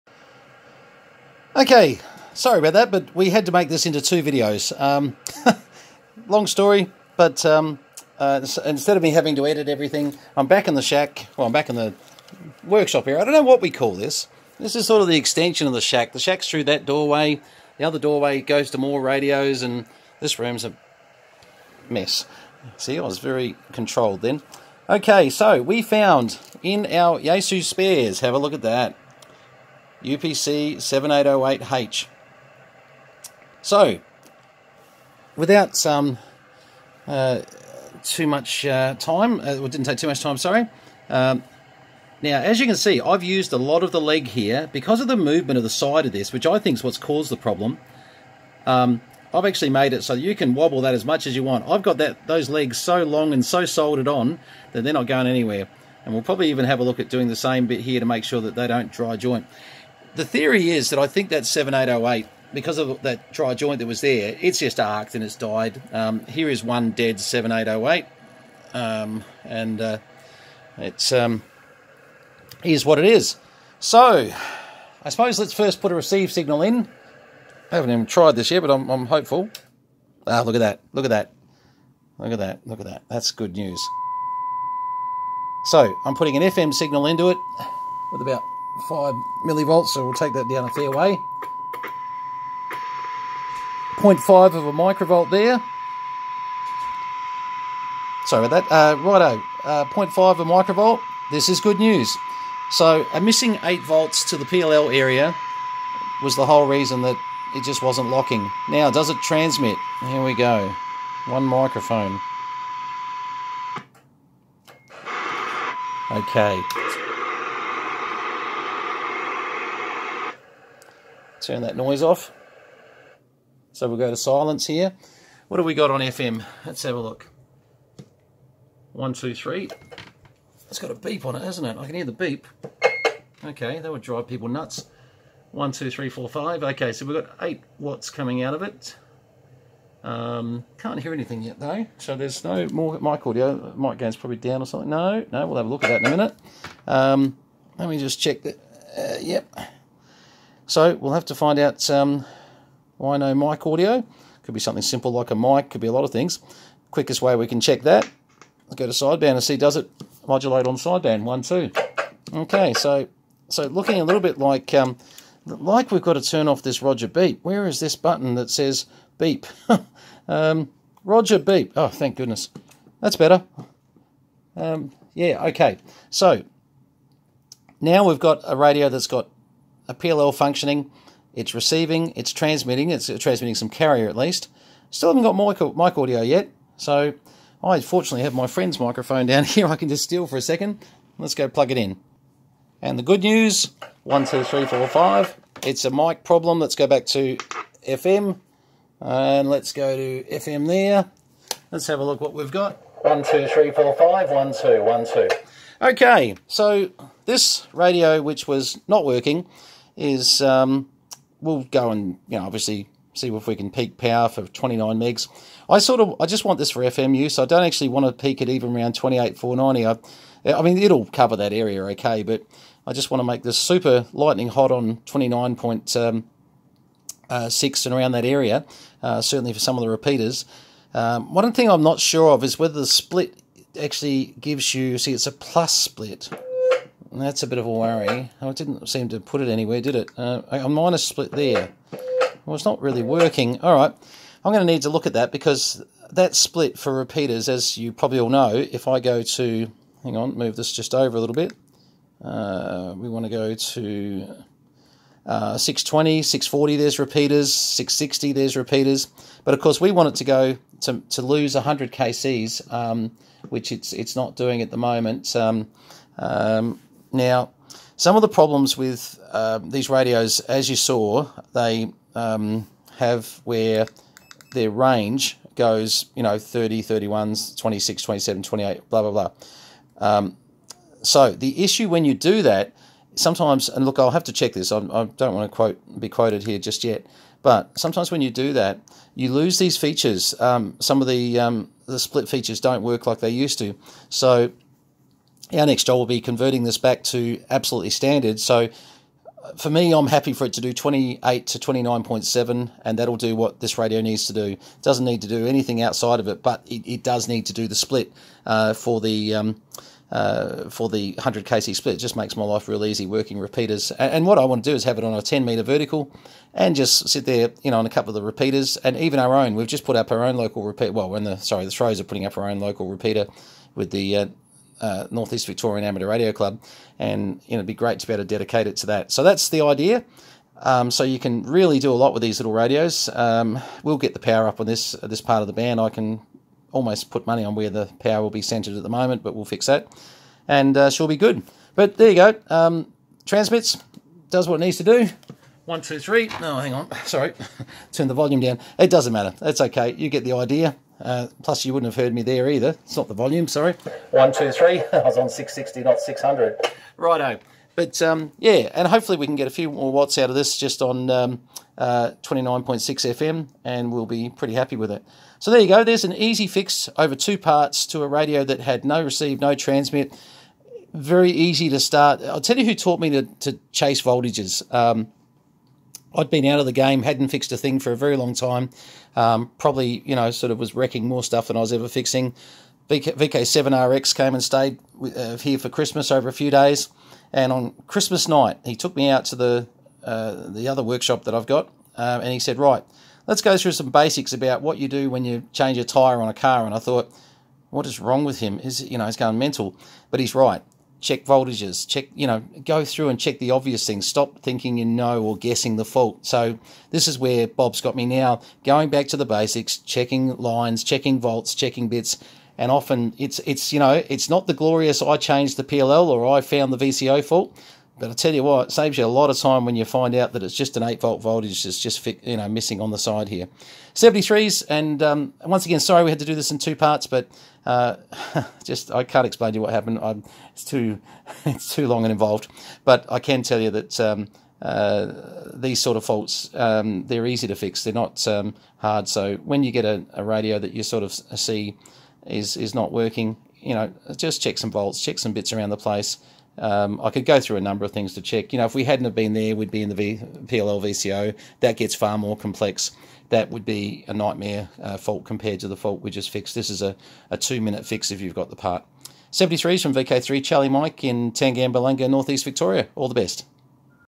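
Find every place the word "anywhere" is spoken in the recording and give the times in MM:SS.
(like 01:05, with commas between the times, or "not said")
00:55, 03:59.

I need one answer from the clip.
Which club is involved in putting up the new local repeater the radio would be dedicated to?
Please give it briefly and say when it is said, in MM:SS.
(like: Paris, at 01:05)
Northeast Victorian Amateur Radio Club, at 05:25.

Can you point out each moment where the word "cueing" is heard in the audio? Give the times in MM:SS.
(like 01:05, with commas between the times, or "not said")
not said.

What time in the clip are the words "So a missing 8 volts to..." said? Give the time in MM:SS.
01:42.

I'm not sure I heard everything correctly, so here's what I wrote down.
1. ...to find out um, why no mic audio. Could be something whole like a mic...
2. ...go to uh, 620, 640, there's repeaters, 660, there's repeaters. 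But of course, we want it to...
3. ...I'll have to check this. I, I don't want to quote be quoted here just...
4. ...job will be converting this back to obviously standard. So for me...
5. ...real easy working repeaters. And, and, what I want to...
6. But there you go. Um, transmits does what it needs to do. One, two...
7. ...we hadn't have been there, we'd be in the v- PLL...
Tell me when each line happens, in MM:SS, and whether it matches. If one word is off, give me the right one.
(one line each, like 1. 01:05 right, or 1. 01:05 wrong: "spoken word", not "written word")
1. 02:31 wrong: "simple", not "whole"
2. 04:13 right
3. 04:43 right
4. 04:55 wrong: "absolutely", not "obviously"
5. 05:12 right
6. 05:41 right
7. 07:28 right.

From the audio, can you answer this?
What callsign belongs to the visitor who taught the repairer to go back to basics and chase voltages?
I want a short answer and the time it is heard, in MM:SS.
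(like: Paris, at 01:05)
VK7RX, at 06:23.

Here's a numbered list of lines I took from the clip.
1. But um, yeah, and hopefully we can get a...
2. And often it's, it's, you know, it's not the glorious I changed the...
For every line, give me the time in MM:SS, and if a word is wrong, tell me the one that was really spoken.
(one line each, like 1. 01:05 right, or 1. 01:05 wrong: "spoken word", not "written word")
1. 05:57 right
2. 06:52 right.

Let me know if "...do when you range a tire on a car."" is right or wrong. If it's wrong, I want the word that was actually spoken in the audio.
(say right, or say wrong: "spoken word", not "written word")
wrong: "change", not "range".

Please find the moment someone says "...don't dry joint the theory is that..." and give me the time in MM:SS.
00:58.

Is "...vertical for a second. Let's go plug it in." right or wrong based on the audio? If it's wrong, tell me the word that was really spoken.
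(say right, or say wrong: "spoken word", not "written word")
wrong: "steal", not "vertical".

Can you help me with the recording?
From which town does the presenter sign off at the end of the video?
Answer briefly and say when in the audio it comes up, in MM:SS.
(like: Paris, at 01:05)
Tangambalanga, at 07:41.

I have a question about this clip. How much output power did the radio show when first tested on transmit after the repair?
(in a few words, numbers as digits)
8 watts.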